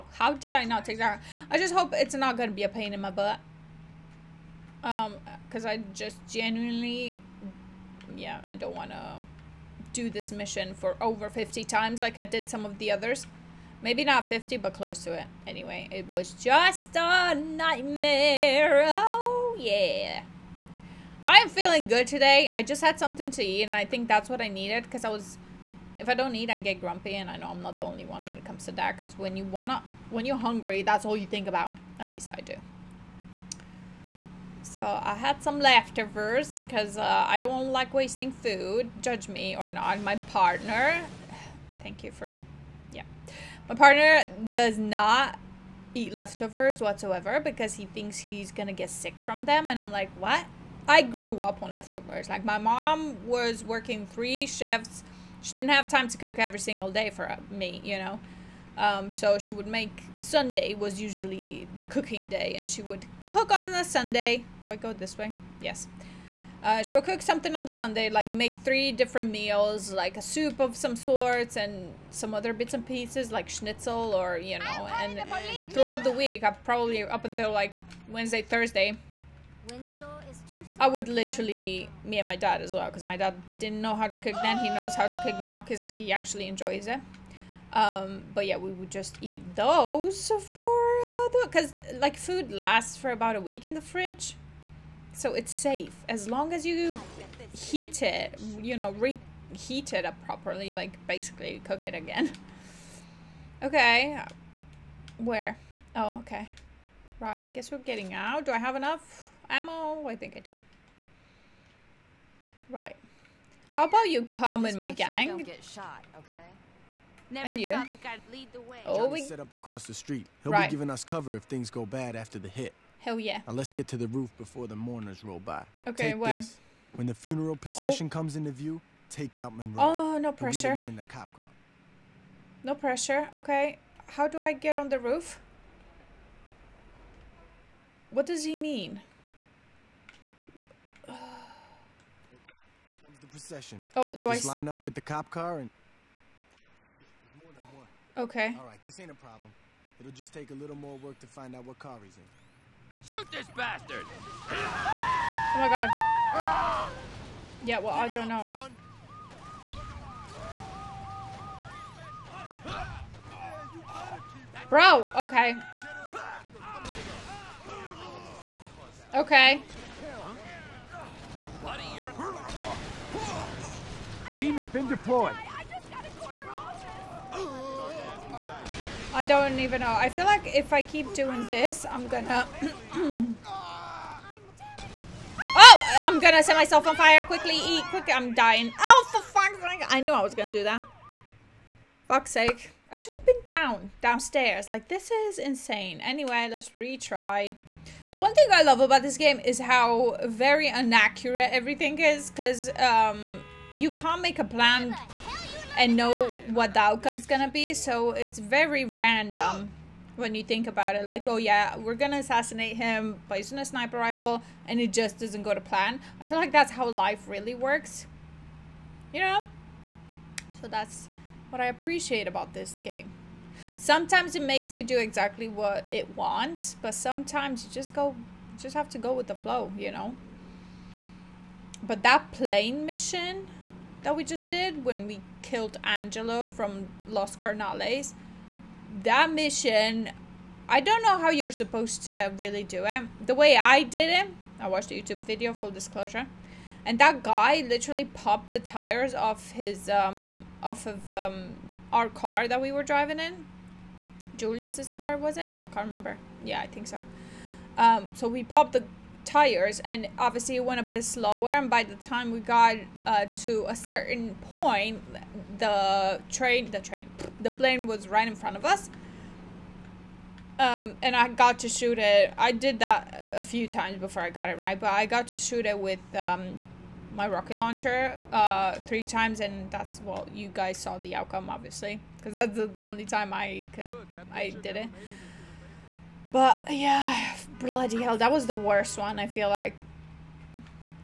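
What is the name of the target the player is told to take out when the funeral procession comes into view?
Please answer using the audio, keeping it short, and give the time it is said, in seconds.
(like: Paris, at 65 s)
Monroe, at 129 s.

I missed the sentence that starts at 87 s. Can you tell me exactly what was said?
Um, but yeah, we would just eat those for, because uh, like food lasts for about a week in the fridge.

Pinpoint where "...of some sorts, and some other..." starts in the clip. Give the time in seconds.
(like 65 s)
70 s.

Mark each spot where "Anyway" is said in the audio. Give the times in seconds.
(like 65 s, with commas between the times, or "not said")
15 s, 196 s.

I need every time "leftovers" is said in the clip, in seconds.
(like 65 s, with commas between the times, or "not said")
35 s, 46 s, 51 s.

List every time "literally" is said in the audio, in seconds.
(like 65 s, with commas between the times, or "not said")
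81 s, 247 s.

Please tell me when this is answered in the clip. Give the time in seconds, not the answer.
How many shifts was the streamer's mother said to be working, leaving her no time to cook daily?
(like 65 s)
54 s.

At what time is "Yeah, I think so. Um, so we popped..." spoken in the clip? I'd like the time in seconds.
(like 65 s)
256 s.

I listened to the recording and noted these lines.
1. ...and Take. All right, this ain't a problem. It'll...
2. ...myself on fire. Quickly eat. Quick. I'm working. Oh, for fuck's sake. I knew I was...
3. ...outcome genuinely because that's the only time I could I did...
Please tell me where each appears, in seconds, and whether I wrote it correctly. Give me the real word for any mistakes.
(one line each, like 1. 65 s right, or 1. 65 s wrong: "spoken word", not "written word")
1. 145 s wrong: "Okay", not "Take"
2. 186 s wrong: "dying", not "working"
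3. 281 s wrong: "obviously", not "genuinely".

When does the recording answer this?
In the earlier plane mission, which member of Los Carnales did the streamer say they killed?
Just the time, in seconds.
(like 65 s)
235 s.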